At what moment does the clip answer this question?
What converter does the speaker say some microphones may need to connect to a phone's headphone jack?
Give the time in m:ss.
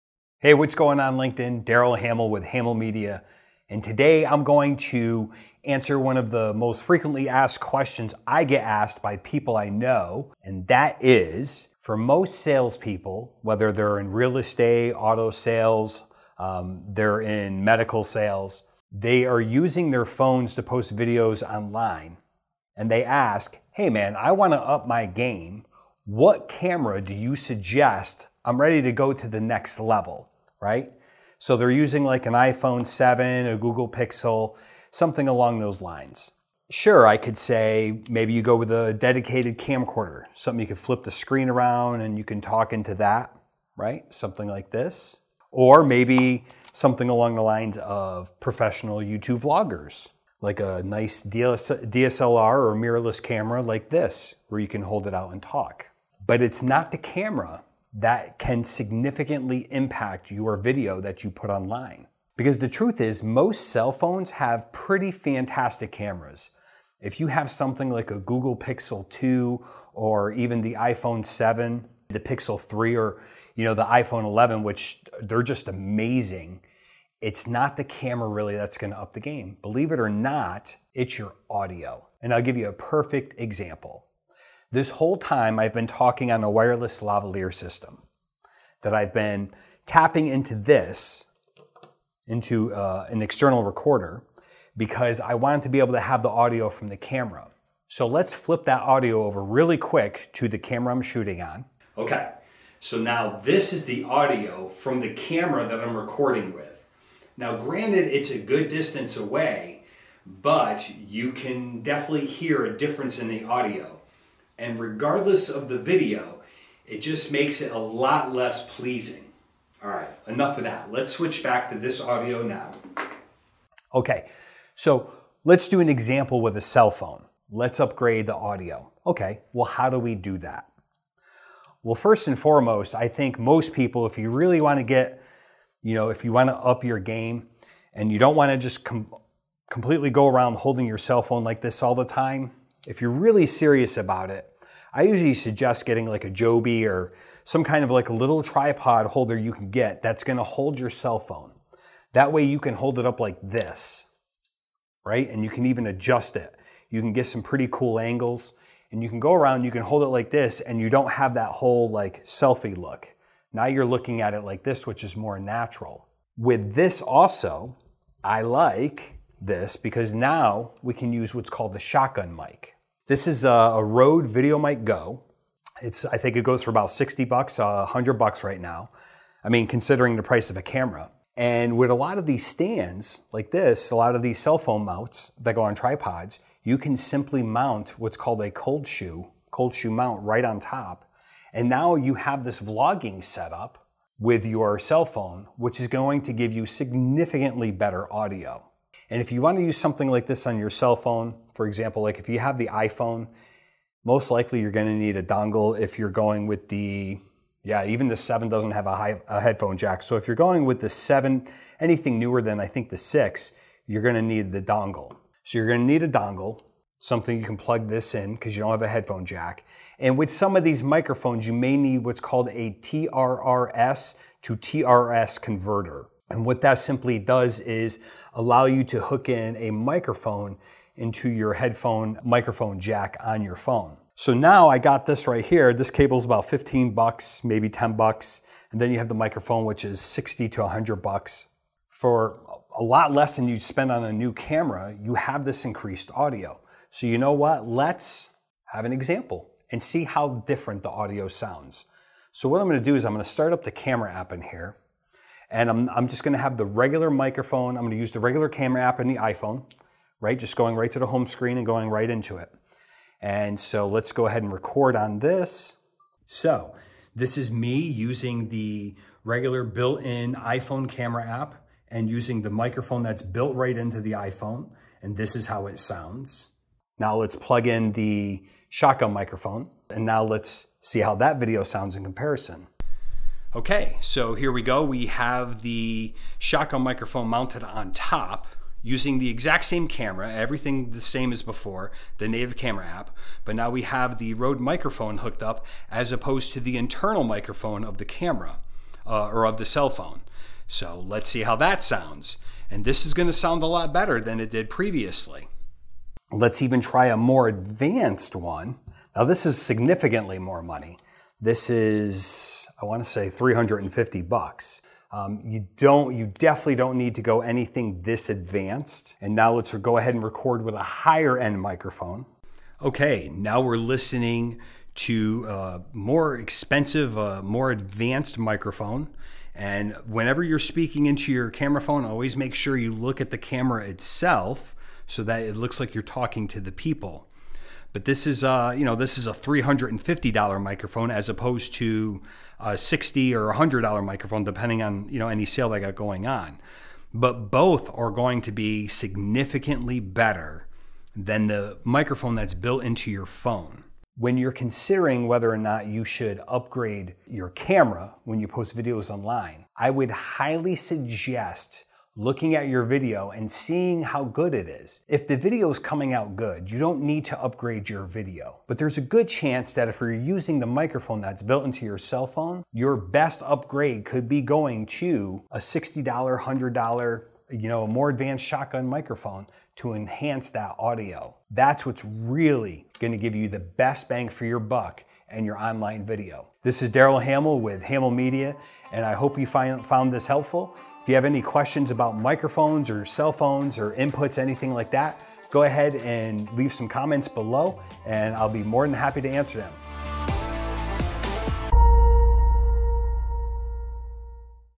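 3:42.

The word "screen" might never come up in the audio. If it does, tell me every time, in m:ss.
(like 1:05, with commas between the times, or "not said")
0:41, 4:21.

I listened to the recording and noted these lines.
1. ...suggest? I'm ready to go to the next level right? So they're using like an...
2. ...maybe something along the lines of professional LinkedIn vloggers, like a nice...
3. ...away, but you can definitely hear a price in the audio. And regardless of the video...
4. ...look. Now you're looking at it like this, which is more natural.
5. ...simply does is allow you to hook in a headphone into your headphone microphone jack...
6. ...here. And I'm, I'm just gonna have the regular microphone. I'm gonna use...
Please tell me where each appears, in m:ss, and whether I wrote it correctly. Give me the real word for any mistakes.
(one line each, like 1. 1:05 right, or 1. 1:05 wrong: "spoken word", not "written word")
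1. 0:27 right
2. 0:45 wrong: "YouTube", not "LinkedIn"
3. 1:49 wrong: "difference", not "price"
4. 2:42 right
5. 3:46 wrong: "microphone", not "headphone"
6. 4:14 right.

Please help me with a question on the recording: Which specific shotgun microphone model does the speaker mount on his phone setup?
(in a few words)
Rode VideoMic Go.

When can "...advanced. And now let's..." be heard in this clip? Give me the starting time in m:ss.
5:18.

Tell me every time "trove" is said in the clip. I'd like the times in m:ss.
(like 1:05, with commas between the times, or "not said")
not said.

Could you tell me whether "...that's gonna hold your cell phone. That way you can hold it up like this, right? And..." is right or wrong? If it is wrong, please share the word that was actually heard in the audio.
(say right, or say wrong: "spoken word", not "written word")
right.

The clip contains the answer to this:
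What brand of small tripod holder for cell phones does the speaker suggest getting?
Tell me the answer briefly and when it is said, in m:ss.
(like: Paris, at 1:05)
Joby, at 2:26.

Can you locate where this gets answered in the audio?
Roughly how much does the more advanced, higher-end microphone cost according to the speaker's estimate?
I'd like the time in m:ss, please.
5:13.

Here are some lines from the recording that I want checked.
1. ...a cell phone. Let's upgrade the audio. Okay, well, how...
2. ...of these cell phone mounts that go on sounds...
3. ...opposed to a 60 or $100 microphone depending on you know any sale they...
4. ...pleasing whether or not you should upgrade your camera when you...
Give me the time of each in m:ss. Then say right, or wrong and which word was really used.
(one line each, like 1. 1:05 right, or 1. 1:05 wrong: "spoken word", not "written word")
1. 2:06 right
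2. 3:04 wrong: "tripods", not "sounds"
3. 5:41 right
4. 5:54 wrong: "considering", not "pleasing".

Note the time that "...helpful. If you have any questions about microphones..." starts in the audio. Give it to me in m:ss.
6:30.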